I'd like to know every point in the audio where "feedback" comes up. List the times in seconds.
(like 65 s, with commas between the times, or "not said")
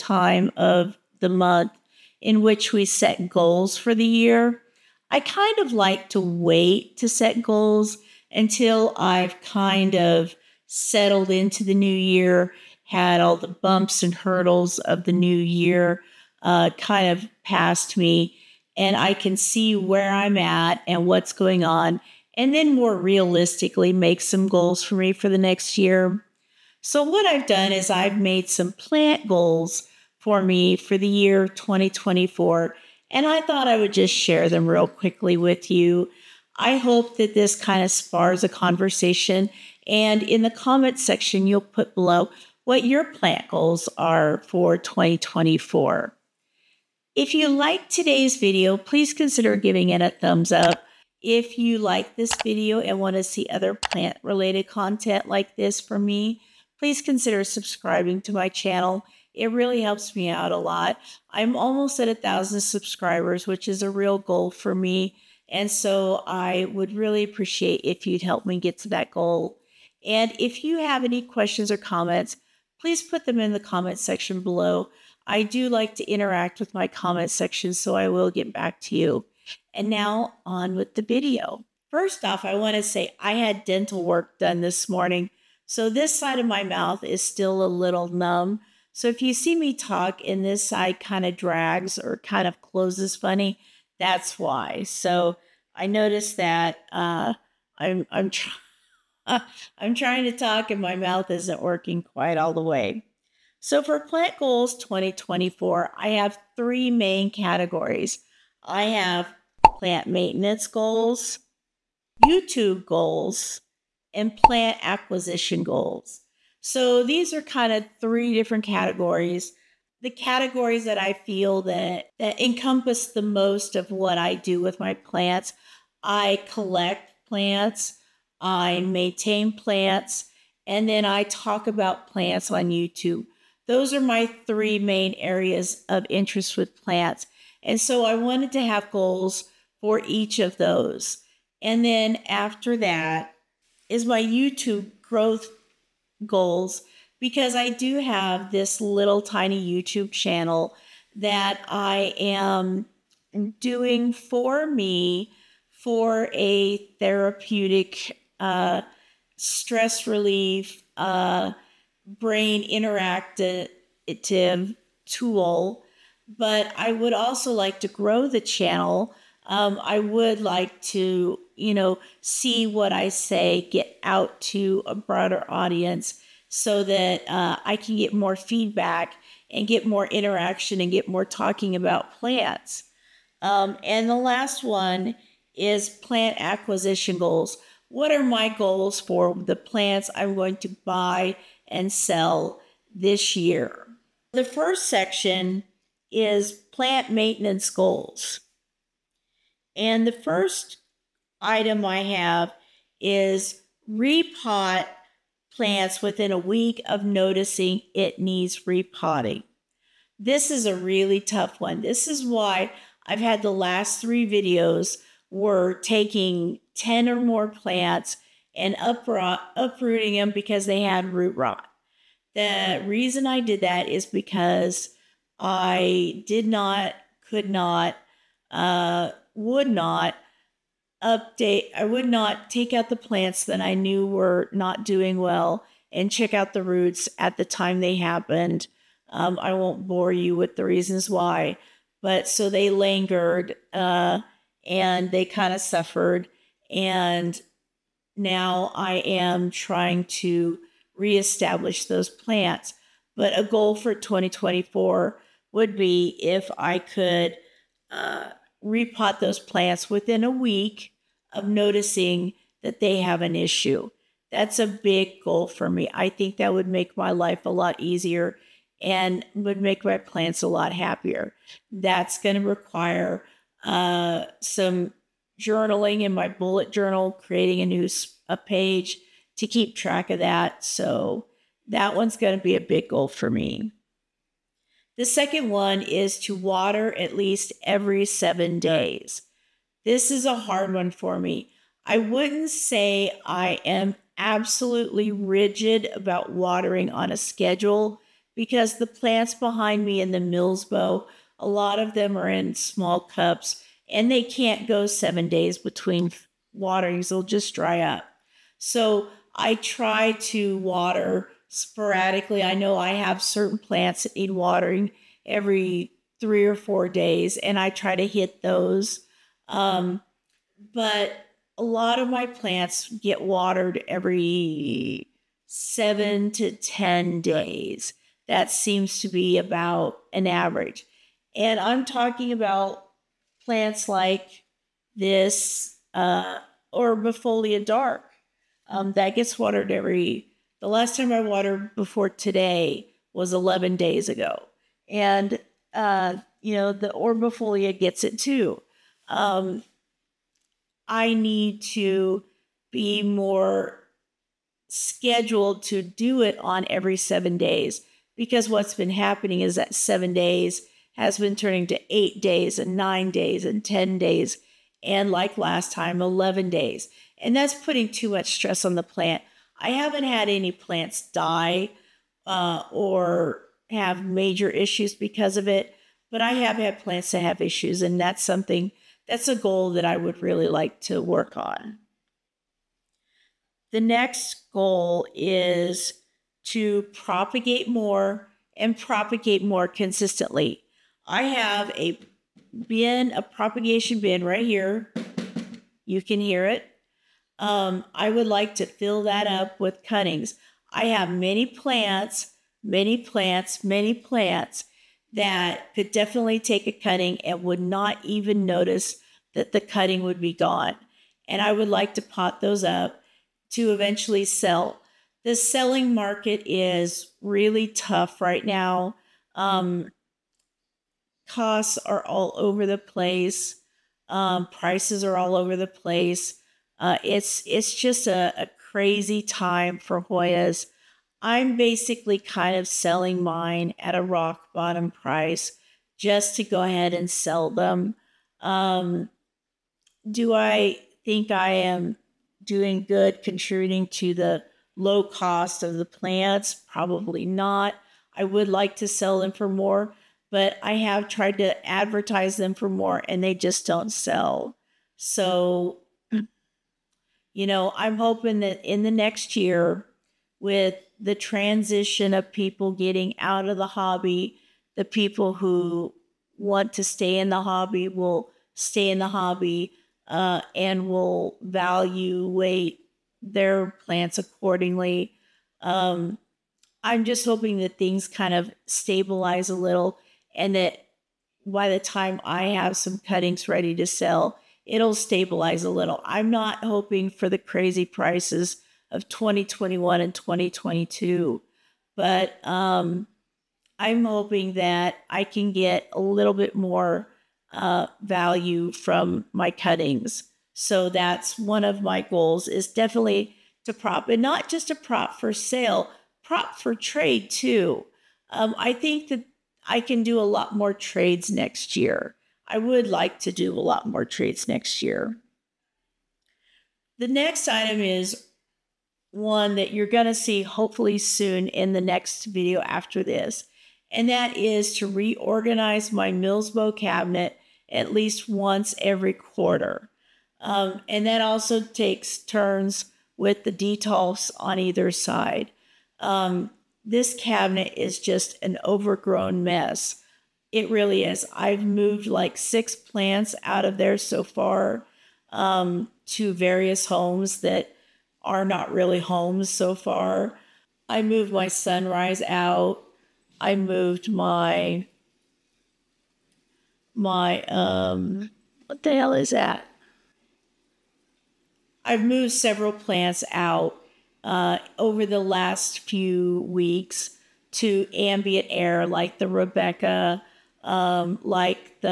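178 s.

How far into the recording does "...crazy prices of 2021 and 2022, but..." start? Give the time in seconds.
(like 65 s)
487 s.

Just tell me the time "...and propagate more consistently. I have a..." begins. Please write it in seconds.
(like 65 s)
388 s.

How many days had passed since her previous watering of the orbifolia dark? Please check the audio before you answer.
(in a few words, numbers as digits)
11 days.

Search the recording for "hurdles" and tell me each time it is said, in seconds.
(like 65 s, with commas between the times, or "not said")
14 s.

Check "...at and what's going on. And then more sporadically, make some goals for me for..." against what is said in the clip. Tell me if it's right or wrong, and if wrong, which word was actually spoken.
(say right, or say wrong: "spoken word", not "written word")
wrong: "realistically", not "sporadically".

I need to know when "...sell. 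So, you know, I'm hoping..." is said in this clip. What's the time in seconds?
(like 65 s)
453 s.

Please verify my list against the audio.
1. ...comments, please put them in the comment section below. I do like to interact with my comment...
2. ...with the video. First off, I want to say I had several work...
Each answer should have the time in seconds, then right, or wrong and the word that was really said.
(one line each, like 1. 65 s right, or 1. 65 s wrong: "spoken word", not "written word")
1. 71 s right
2. 80 s wrong: "dental", not "several".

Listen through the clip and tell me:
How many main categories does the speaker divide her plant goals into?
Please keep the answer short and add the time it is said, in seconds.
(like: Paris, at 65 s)
3, at 106 s.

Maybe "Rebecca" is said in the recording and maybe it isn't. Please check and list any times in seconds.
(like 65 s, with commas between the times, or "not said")
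569 s.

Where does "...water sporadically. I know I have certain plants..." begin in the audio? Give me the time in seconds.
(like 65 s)
310 s.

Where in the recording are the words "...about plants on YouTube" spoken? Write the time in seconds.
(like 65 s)
131 s.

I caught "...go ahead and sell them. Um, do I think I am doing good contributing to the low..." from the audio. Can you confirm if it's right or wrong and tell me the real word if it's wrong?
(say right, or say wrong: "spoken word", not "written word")
right.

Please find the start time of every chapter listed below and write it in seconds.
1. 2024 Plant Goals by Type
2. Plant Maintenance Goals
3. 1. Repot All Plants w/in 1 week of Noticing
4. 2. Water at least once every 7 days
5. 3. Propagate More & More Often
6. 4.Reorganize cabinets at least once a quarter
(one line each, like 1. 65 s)
1. 108 s
2. 193 s
3. 203 s
4. 283 s
5. 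382 s
6. 524 s.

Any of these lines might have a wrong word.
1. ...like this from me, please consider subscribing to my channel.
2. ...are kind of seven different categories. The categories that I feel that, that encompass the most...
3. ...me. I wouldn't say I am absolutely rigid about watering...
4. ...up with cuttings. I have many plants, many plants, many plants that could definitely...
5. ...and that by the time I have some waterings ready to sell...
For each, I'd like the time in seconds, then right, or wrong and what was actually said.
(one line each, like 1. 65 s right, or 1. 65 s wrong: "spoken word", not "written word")
1. 55 s right
2. 117 s wrong: "three", not "seven"
3. 291 s right
4. 399 s right
5. 480 s wrong: "cuttings", not "waterings".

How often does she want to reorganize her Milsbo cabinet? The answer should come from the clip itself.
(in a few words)
once every quarter.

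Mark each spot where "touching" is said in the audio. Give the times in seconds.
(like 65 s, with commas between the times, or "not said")
not said.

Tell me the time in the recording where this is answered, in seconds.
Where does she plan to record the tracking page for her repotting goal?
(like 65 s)
276 s.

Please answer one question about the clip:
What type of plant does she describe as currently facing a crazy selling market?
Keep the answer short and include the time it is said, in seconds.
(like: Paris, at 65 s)
Hoyas, at 430 s.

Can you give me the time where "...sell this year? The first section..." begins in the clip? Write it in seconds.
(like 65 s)
191 s.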